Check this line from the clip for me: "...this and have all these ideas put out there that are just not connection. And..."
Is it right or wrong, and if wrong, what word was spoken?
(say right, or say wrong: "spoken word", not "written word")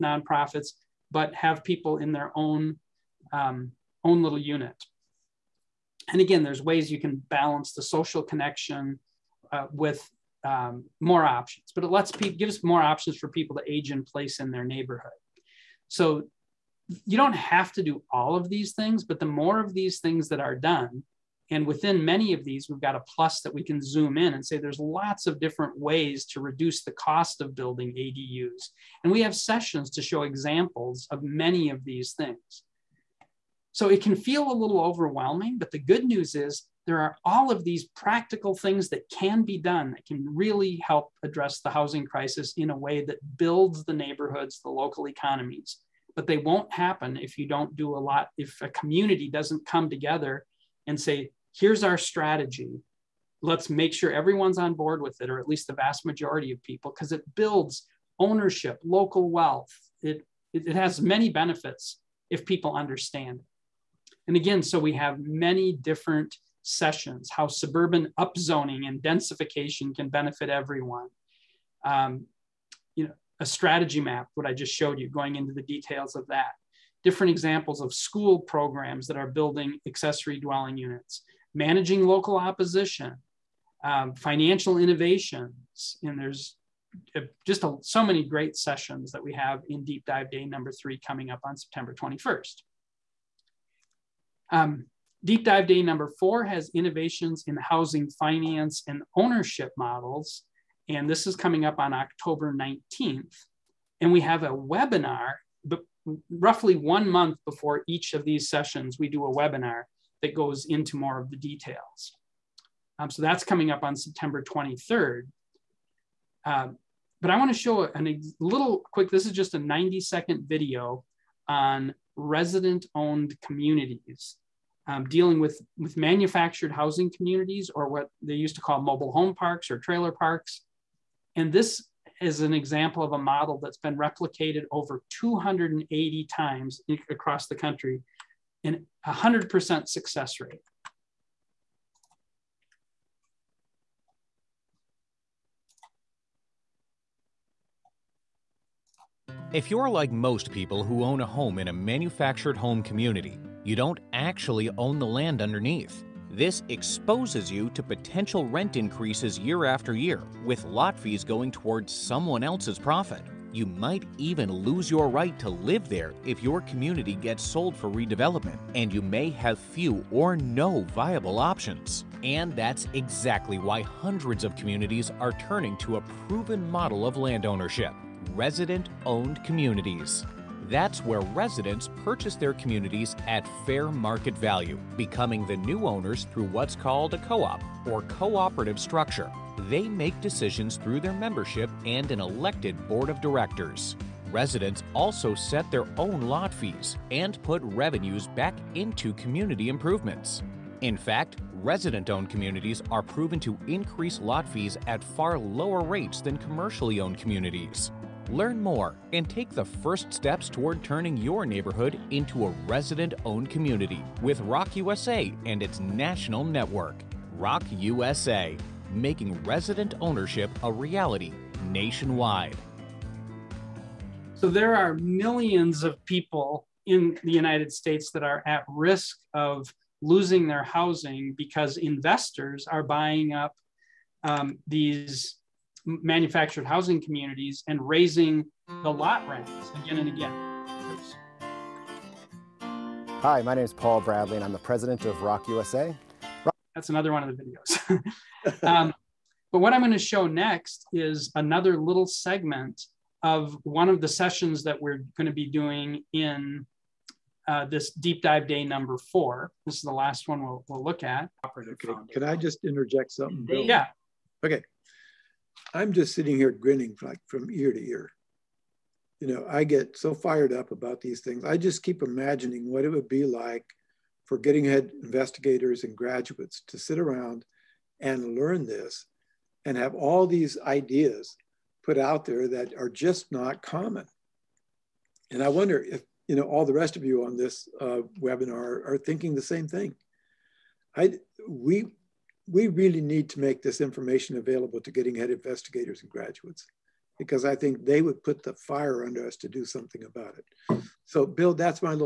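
wrong: "common", not "connection".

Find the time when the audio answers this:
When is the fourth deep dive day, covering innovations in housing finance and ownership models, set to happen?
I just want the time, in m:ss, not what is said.
1:41.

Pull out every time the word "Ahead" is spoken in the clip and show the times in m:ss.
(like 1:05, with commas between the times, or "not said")
4:34, 4:55.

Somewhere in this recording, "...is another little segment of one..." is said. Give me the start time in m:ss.
4:10.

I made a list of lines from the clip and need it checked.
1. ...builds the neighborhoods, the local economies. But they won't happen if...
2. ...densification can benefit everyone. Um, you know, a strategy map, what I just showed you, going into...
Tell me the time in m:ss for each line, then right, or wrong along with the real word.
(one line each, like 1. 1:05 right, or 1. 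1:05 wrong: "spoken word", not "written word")
1. 0:43 right
2. 1:09 right.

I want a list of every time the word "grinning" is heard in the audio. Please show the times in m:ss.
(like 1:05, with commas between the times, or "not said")
4:26.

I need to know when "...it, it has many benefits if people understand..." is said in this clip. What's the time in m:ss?
1:00.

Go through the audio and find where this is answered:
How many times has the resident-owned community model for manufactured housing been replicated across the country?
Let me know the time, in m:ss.
2:14.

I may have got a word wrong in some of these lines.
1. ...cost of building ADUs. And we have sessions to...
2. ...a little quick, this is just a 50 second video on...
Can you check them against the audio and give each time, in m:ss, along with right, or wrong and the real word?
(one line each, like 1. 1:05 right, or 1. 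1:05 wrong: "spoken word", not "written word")
1. 0:26 right
2. 1:57 wrong: "90", not "50".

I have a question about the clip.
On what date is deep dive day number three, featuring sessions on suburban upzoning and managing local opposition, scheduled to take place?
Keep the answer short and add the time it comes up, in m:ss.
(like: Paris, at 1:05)
September 21st, at 1:31.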